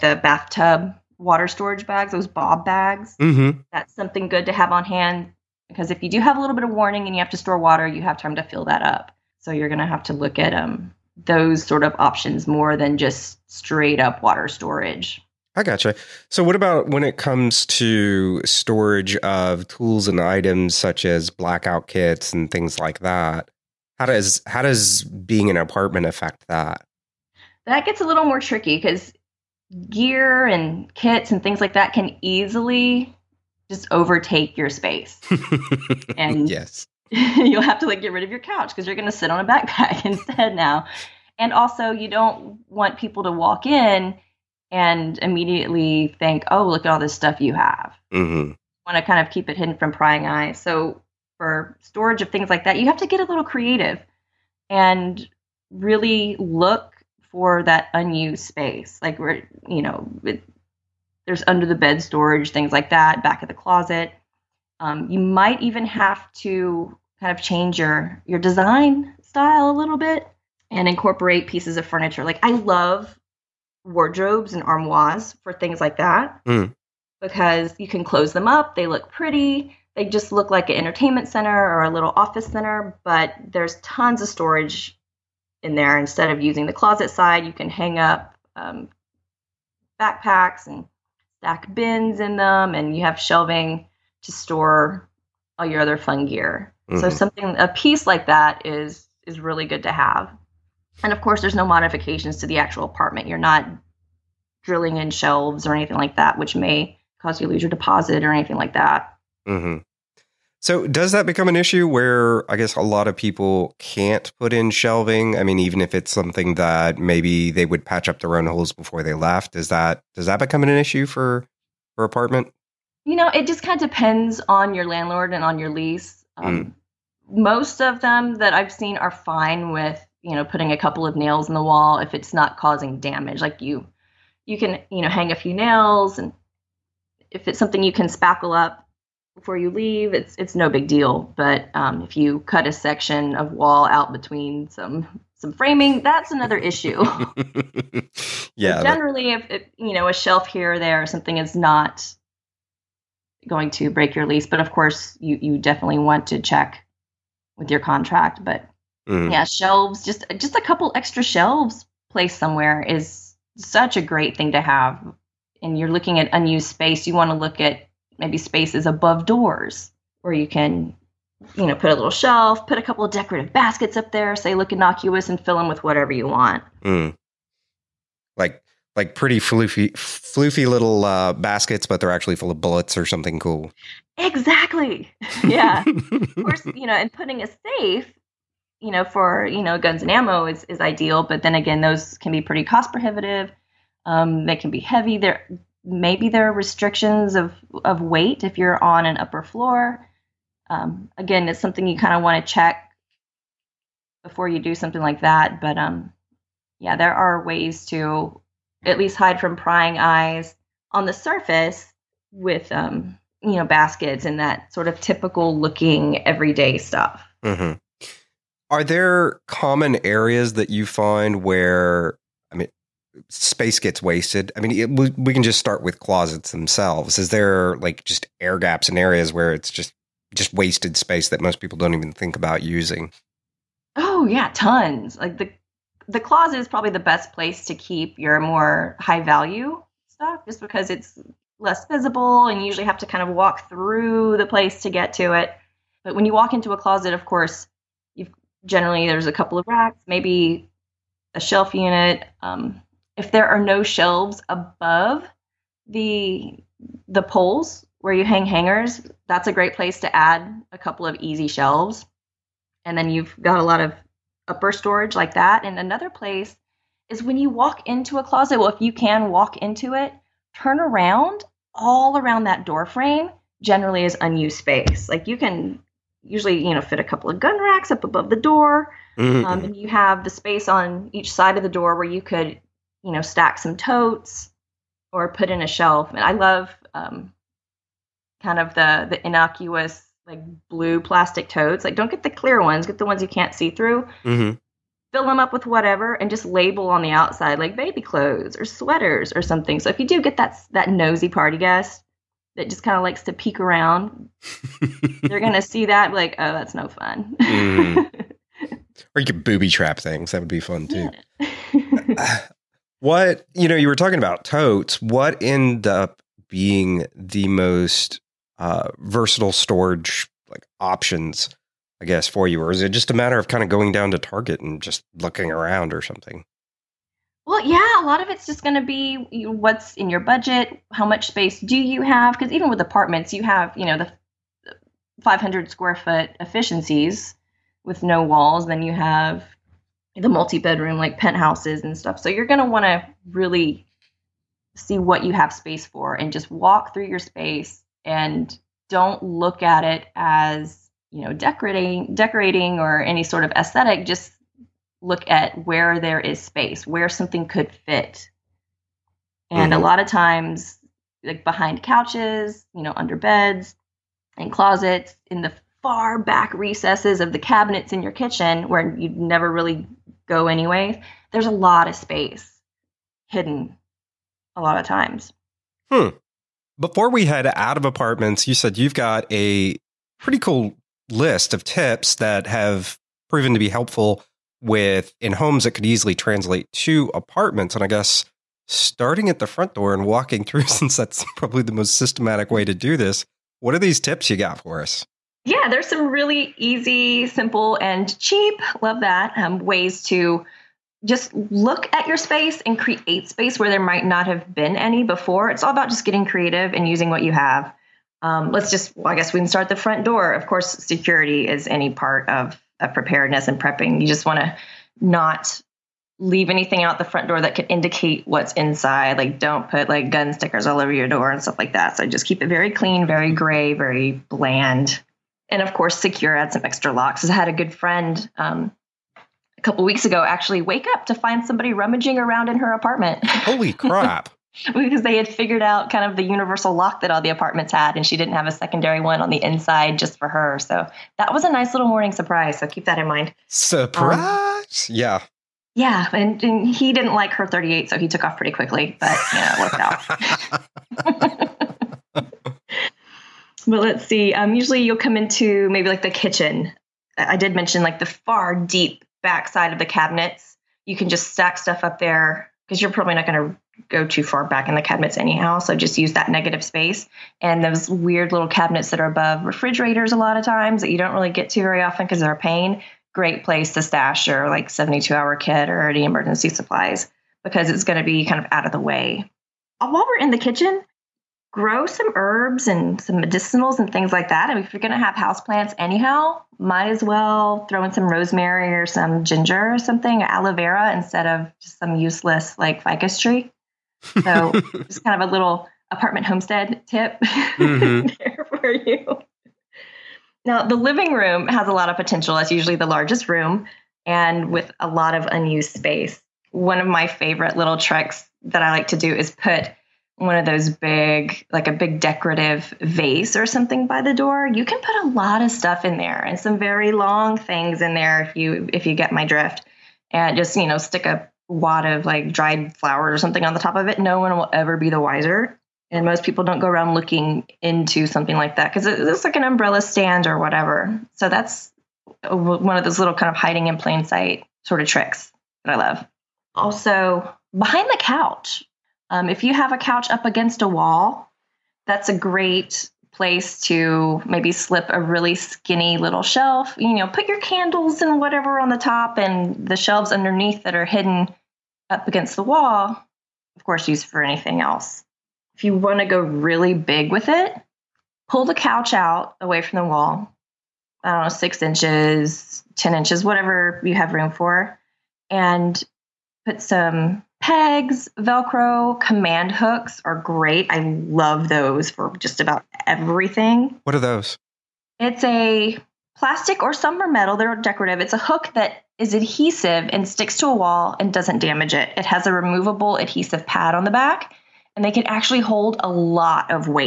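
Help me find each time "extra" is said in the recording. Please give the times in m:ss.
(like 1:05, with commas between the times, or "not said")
2:40, 7:06.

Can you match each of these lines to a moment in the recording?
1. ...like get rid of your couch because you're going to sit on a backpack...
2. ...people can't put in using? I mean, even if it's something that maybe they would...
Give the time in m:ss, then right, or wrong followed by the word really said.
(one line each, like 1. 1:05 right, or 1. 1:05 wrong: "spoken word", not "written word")
1. 0:37 right
2. 1:53 wrong: "shelving", not "using".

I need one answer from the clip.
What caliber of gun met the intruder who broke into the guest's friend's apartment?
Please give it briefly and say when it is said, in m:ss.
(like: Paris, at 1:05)
.38, at 7:27.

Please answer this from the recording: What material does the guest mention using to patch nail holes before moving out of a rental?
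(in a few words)
Spackle.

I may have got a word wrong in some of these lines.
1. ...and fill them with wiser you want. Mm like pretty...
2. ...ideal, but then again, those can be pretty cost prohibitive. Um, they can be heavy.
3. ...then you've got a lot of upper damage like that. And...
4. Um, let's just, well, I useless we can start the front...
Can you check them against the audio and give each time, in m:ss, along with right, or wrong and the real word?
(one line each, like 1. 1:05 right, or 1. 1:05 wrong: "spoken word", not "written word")
1. 2:55 wrong: "whatever", not "wiser"
2. 3:10 right
3. 4:22 wrong: "storage", not "damage"
4. 6:48 wrong: "guess", not "useless".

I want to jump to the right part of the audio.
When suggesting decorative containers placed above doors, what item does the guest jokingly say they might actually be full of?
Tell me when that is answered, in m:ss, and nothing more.
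3:02.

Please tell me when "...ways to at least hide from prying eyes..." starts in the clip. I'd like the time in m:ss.
3:27.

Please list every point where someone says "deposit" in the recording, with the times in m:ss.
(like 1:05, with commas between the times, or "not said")
1:47.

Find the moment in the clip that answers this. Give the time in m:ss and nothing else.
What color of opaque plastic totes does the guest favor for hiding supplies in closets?
4:50.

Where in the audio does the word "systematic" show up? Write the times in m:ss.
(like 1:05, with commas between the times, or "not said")
6:31.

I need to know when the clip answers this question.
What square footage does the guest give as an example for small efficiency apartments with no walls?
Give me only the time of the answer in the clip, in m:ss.
5:35.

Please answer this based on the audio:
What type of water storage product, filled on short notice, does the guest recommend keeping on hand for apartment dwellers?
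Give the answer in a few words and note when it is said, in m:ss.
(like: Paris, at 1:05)
Bathtub water storage bags, at 0:00.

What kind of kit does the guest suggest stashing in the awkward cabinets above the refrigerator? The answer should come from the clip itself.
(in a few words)
72 hour kit.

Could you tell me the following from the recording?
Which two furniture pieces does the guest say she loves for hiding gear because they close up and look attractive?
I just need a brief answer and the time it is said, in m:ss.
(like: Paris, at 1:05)
Wardrobes and armoires, at 1:13.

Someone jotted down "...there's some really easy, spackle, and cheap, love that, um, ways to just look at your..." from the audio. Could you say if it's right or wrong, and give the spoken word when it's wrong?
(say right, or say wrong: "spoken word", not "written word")
wrong: "simple", not "spackle".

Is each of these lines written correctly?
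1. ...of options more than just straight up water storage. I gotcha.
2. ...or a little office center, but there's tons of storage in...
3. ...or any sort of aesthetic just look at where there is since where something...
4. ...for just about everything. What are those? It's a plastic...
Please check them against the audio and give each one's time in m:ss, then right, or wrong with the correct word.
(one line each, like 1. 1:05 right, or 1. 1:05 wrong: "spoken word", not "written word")
1. 0:11 right
2. 1:21 right
3. 5:52 wrong: "space", not "since"
4. 9:31 right.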